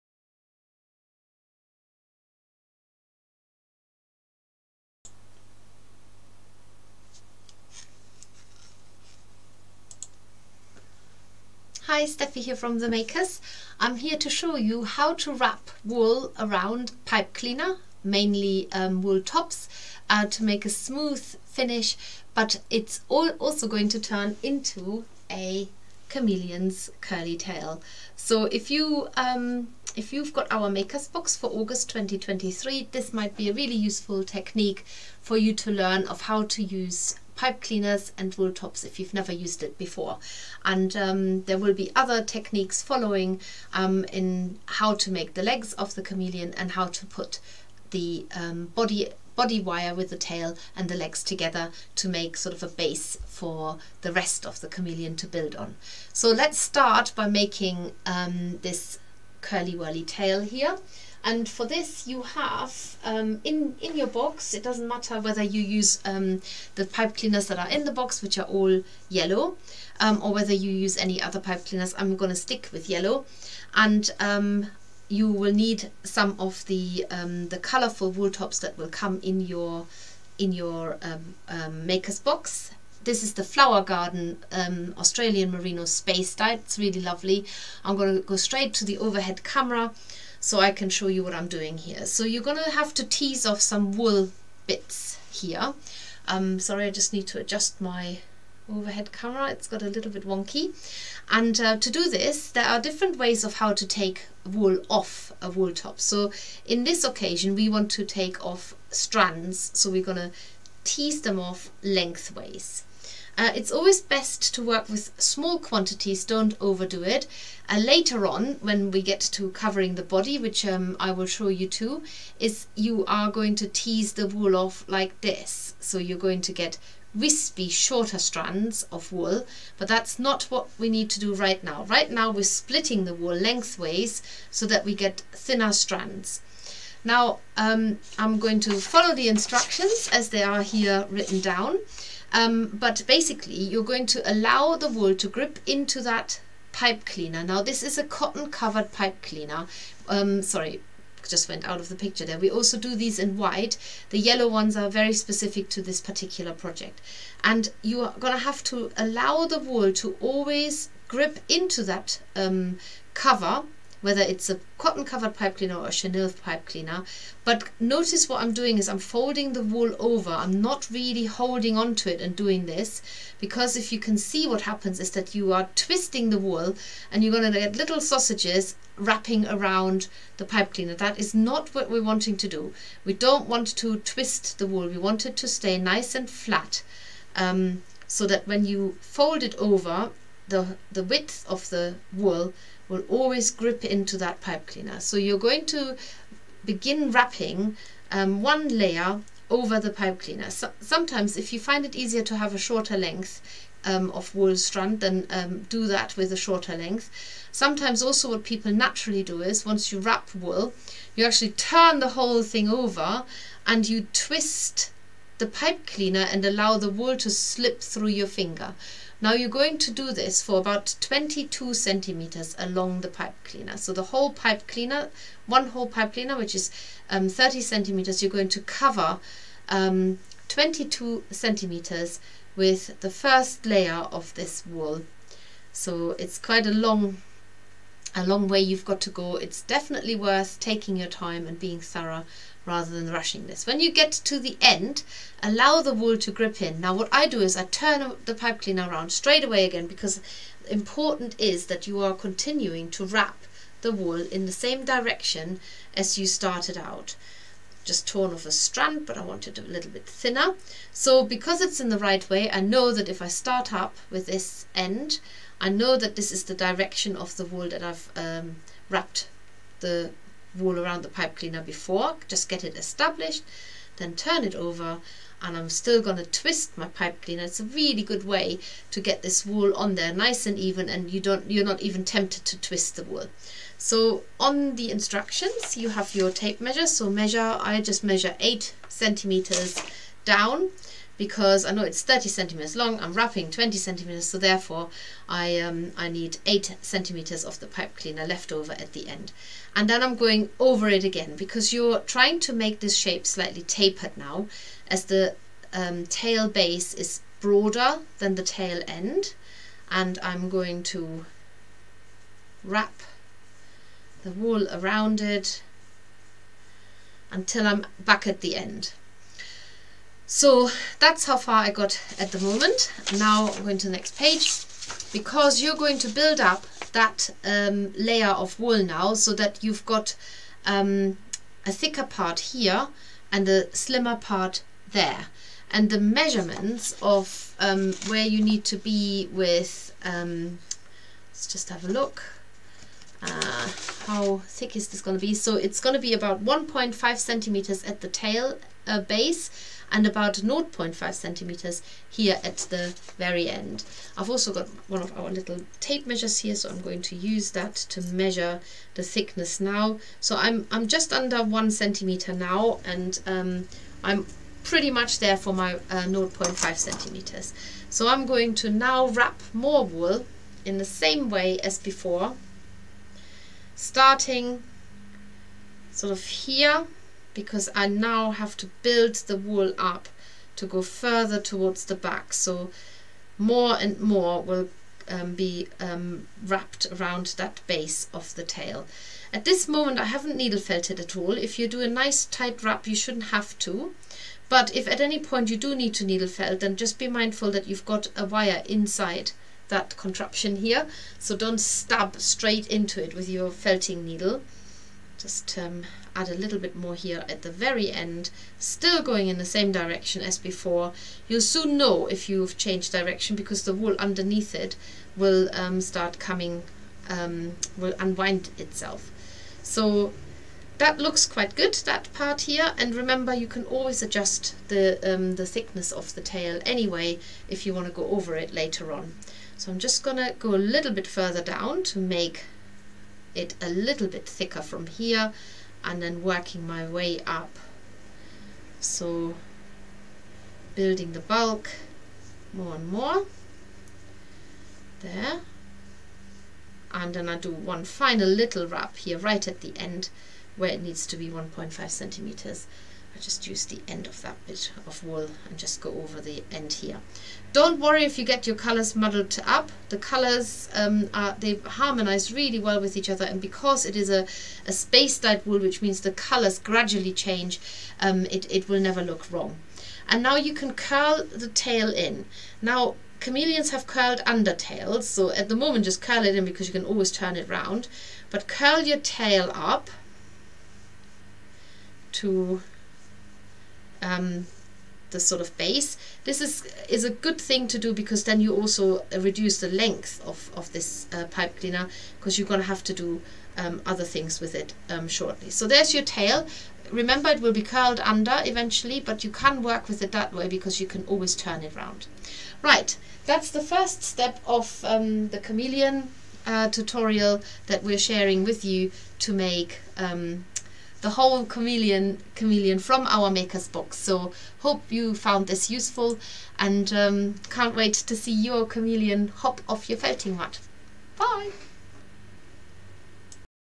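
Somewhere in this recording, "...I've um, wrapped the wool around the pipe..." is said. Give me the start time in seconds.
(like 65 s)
267 s.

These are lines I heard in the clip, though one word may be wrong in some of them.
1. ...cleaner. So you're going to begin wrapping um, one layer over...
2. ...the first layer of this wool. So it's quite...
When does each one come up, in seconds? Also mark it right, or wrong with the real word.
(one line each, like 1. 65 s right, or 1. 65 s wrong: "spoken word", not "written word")
1. 194 s right
2. 233 s right.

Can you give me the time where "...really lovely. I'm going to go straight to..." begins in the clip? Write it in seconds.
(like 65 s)
86 s.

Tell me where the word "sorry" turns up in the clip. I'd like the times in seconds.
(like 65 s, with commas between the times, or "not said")
96 s, 150 s.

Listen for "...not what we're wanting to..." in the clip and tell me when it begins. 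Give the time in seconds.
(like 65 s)
181 s.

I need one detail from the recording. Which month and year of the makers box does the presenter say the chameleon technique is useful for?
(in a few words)
August 2023.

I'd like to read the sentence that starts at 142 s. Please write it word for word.
Um, but basically, you're going to allow the wool to grip into that pipe cleaner.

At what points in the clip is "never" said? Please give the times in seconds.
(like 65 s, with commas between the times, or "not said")
39 s, 468 s.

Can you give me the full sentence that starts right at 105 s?
So in this occasion, we want to take off strands.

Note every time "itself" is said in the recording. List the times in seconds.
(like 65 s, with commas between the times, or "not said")
418 s.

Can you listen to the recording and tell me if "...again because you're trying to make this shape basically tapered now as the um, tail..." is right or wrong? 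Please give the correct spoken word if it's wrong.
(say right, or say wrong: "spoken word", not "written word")
wrong: "slightly", not "basically".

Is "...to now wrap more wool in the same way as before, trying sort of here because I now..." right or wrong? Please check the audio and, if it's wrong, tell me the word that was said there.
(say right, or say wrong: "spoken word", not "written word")
wrong: "starting", not "trying".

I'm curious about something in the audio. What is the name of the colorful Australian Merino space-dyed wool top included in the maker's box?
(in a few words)
Flower Garden.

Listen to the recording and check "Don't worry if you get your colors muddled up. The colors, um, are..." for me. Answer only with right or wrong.
right.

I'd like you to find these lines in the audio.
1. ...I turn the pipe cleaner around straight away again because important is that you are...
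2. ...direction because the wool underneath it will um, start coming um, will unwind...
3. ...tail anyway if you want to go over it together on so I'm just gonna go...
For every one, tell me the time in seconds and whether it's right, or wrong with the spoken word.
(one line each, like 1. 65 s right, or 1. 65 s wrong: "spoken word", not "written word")
1. 247 s right
2. 412 s right
3. 426 s wrong: "later", not "together".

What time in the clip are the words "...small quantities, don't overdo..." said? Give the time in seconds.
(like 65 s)
115 s.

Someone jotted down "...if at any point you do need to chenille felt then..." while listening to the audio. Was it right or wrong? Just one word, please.
wrong.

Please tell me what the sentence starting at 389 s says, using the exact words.
At this moment I haven't needle felted at all.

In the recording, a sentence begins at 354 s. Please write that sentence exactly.
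I've also got one of our little tape measures here, so I'm going to use that to measure the thickness now.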